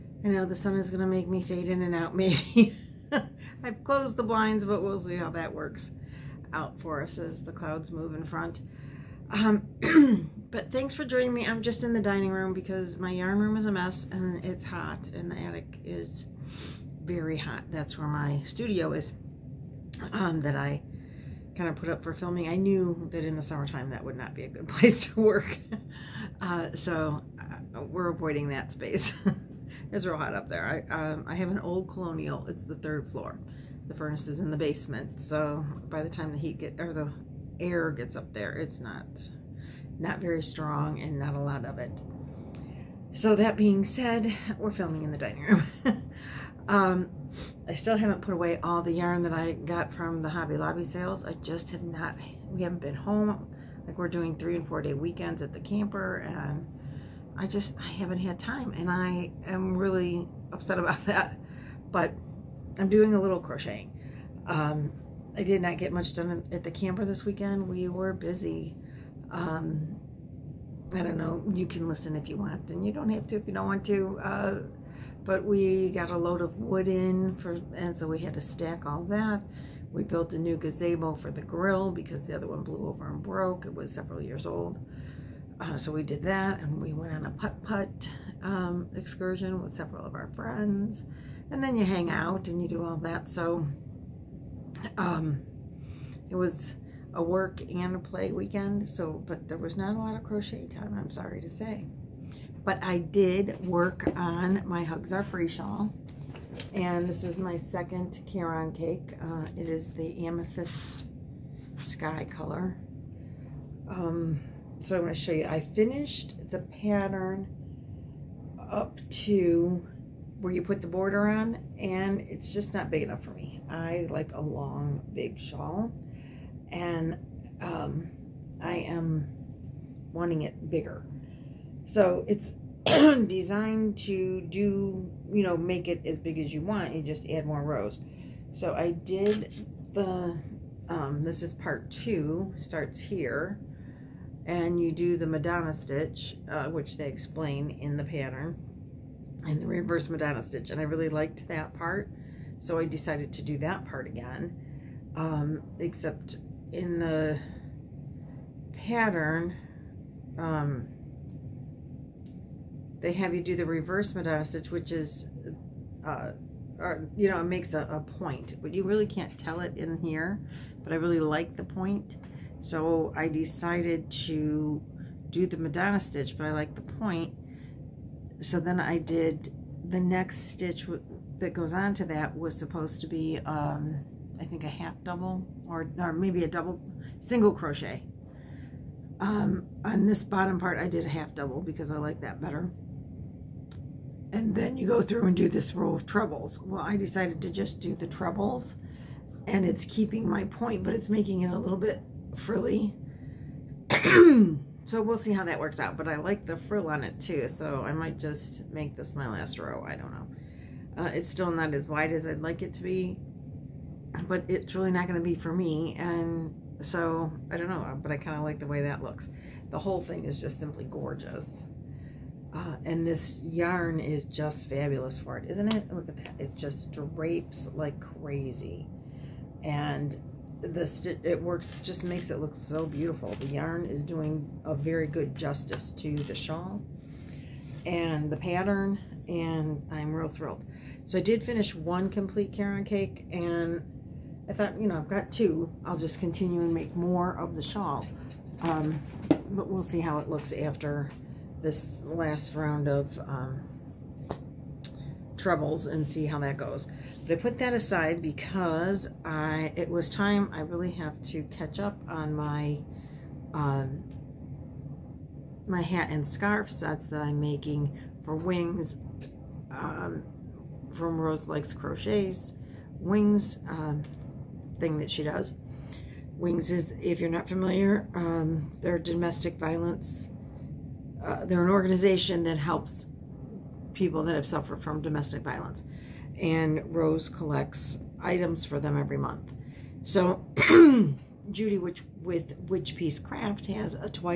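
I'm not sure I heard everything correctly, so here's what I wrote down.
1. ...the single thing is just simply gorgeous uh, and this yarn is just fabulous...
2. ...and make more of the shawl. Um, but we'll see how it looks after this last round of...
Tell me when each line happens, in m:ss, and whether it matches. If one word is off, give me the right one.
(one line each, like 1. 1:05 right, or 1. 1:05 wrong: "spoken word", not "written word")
1. 3:39 wrong: "whole", not "single"
2. 4:06 right.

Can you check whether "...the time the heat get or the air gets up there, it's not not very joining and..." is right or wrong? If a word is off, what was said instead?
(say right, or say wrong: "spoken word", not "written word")
wrong: "strong", not "joining".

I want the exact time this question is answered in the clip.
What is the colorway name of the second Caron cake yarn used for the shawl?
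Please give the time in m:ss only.
1:50.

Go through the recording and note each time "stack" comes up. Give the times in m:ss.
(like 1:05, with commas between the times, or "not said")
1:18.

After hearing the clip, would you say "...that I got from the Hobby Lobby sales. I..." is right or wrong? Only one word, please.
right.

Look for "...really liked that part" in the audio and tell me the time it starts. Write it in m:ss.
2:30.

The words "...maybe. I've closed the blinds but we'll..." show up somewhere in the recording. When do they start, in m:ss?
0:02.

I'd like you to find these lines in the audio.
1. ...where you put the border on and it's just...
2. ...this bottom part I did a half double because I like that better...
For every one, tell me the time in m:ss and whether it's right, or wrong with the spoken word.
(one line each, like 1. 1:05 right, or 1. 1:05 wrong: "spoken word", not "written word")
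1. 2:00 right
2. 3:10 right.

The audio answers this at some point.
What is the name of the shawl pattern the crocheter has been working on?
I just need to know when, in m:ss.
1:44.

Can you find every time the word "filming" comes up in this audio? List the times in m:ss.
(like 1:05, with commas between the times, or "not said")
0:22, 0:44.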